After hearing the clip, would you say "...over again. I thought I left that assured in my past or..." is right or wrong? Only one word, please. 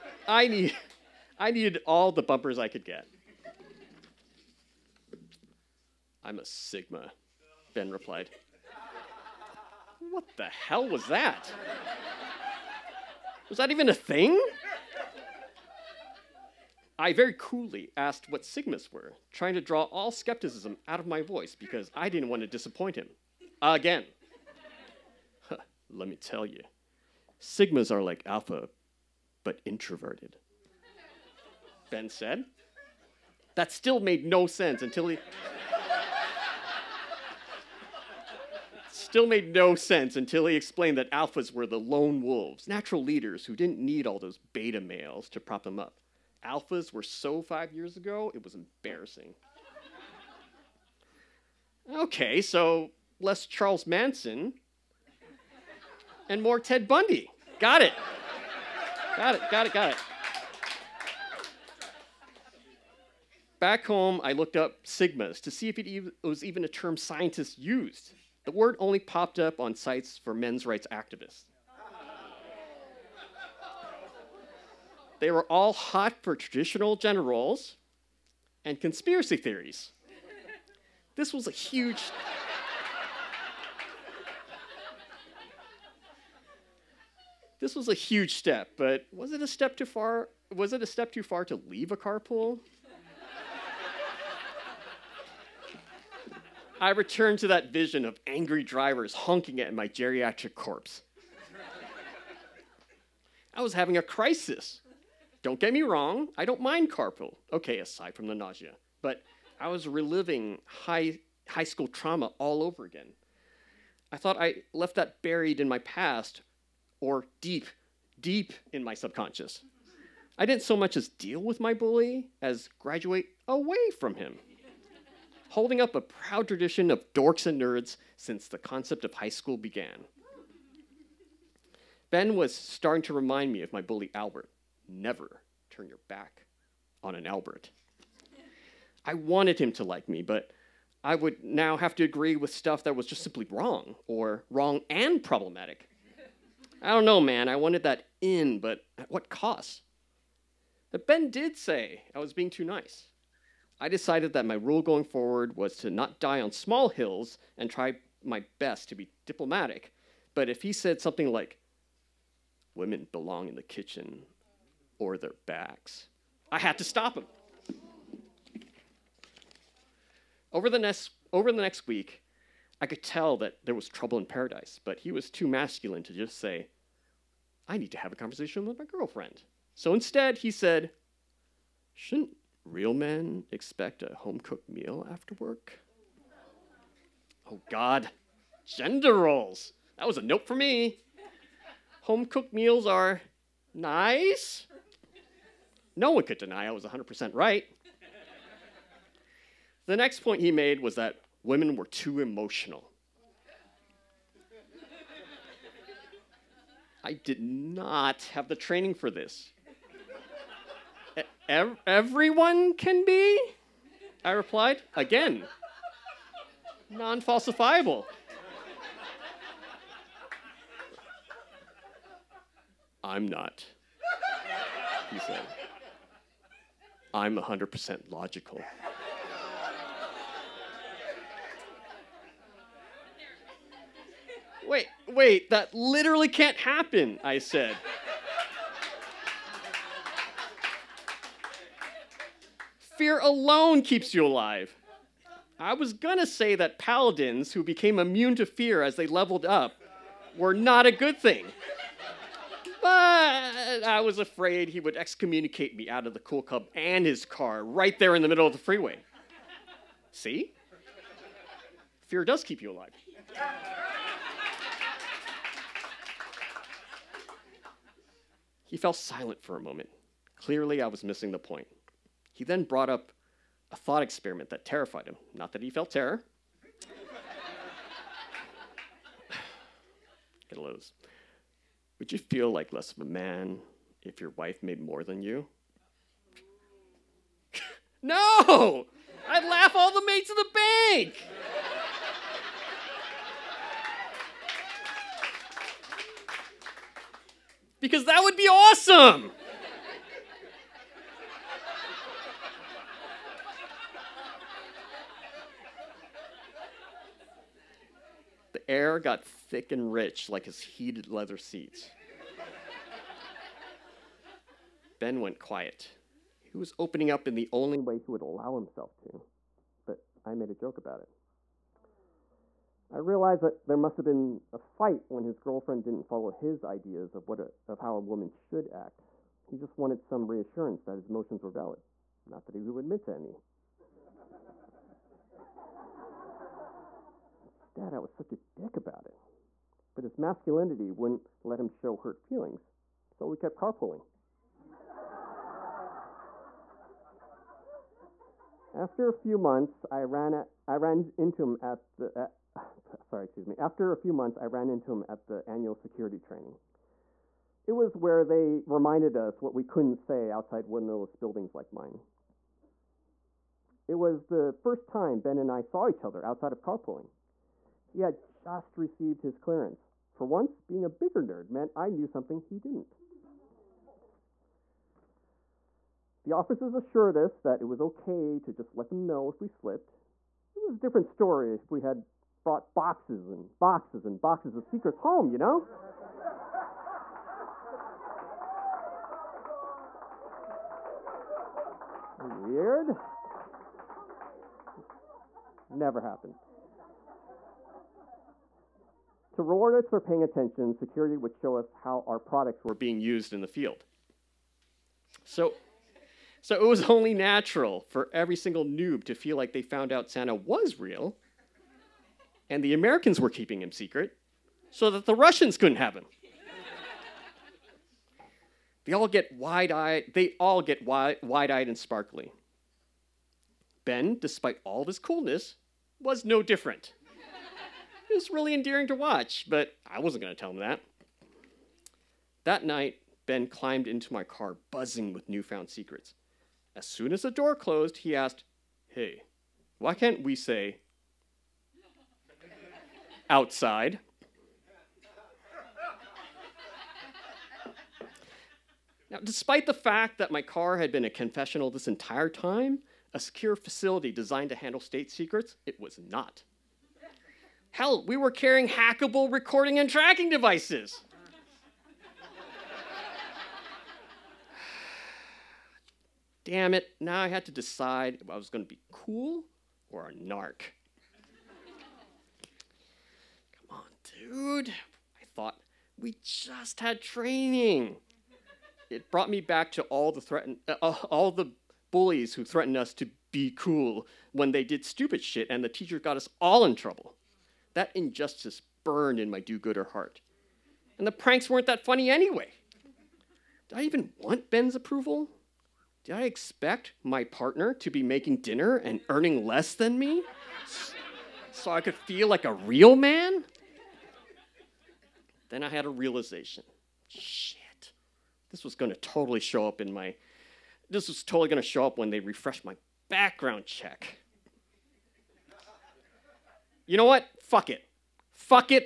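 wrong.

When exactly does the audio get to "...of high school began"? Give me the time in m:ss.
2:09.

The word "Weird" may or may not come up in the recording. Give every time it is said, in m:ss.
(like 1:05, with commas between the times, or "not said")
6:32.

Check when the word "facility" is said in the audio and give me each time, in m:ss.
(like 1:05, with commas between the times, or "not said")
7:33.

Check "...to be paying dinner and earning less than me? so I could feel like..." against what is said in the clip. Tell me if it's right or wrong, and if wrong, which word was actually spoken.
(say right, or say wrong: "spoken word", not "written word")
wrong: "making", not "paying".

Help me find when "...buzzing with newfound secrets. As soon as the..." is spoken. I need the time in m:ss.
7:14.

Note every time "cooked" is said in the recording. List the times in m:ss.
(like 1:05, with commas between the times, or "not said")
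3:04, 3:12.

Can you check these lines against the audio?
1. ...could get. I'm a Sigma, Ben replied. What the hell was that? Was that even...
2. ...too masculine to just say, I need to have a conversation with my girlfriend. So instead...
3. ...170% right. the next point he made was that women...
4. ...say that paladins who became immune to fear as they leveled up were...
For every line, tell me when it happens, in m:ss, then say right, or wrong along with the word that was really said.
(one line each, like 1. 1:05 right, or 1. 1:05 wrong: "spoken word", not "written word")
1. 0:02 right
2. 2:55 right
3. 3:16 wrong: "100", not "170"
4. 4:06 right.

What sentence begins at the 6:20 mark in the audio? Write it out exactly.
It was a different story if we had brought boxes and boxes and boxes of secrets home, you know?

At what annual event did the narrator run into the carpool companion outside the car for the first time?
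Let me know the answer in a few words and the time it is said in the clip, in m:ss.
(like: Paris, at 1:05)
Security training, at 5:55.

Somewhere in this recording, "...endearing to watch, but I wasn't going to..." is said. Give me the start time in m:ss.
7:08.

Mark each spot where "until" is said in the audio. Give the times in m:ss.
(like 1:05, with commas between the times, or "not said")
0:34, 0:40.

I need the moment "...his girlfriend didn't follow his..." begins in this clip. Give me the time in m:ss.
5:25.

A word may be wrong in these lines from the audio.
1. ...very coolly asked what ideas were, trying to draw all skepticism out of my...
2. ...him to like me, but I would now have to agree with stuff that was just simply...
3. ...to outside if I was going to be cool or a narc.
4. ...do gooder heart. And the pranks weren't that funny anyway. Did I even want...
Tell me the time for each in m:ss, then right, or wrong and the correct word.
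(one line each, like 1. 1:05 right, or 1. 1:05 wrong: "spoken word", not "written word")
1. 0:17 wrong: "sigmas", not "ideas"
2. 2:19 right
3. 7:47 wrong: "decide", not "outside"
4. 8:09 right.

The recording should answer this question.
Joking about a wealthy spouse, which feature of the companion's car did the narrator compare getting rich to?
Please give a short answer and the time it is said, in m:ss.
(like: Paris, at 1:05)
Heated leather seats, at 5:10.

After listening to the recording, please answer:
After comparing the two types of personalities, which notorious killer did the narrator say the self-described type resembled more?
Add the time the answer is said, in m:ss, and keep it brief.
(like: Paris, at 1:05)
Ted Bundy, at 0:56.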